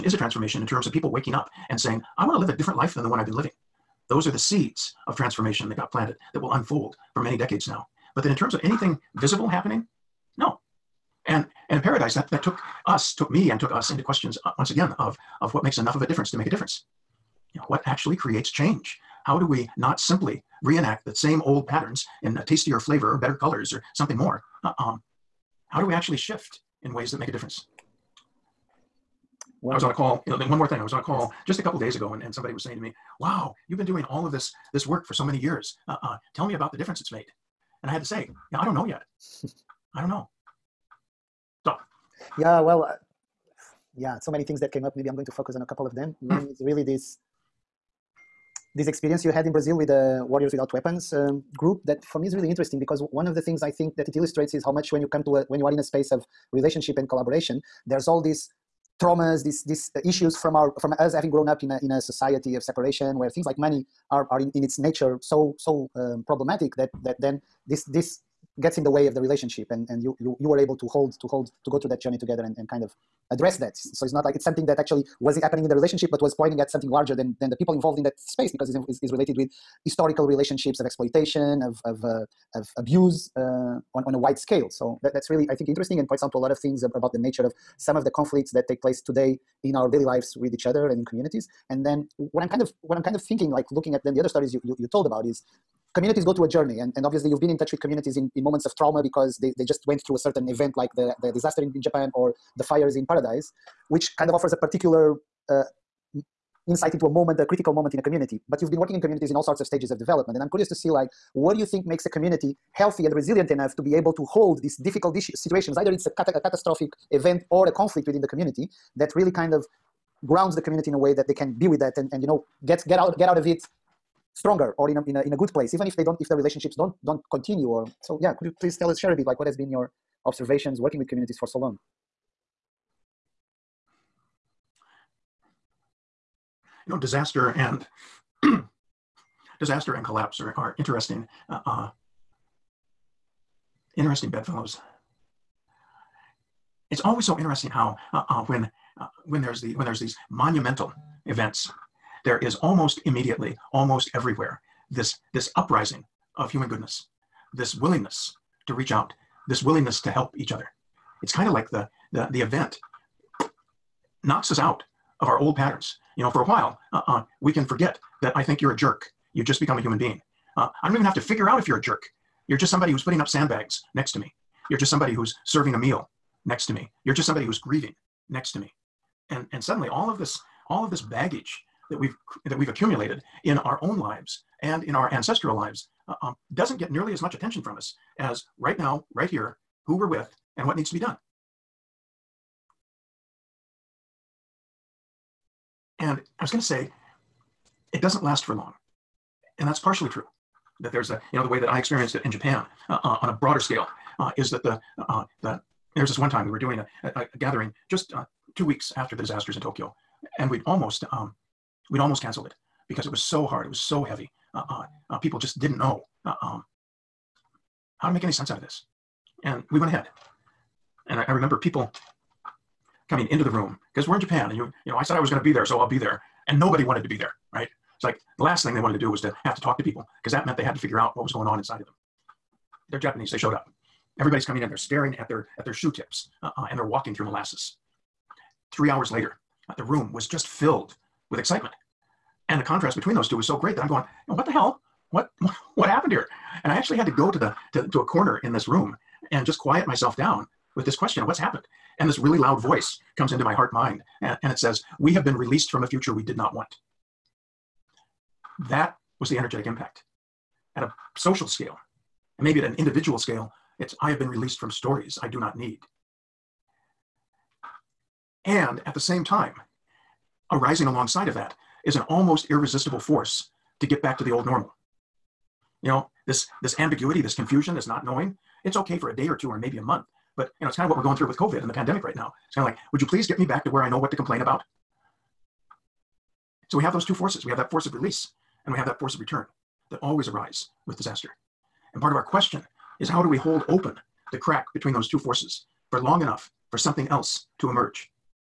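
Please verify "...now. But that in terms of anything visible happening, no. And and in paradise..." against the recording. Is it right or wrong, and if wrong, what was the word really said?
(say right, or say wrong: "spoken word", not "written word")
right.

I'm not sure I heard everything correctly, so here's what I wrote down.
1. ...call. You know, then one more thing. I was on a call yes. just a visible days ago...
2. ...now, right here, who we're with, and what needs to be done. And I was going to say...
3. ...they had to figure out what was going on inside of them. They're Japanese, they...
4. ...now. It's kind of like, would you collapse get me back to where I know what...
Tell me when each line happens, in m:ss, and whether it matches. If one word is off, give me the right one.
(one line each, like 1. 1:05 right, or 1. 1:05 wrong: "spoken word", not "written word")
1. 0:29 wrong: "couple", not "visible"
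2. 3:08 right
3. 3:50 right
4. 4:42 wrong: "please", not "collapse".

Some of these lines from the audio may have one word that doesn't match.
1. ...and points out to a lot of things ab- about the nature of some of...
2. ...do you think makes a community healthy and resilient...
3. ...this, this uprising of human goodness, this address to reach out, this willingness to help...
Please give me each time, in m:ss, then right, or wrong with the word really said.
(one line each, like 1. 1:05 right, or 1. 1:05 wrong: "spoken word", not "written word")
1. 1:25 right
2. 1:51 right
3. 2:34 wrong: "willingness", not "address".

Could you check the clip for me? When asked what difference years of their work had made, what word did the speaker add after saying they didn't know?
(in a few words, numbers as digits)
Yet.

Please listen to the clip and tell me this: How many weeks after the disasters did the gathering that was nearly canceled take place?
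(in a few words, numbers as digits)
2.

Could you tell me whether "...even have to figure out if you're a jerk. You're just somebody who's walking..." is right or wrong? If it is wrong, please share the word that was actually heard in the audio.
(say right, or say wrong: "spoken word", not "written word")
wrong: "putting", not "walking".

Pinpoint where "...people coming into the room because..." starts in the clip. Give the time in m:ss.
3:41.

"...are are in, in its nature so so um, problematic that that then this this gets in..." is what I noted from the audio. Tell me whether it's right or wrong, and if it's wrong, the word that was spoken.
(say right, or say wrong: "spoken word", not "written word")
right.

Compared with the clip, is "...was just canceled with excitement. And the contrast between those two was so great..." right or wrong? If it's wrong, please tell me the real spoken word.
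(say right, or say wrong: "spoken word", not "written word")
wrong: "filled", not "canceled".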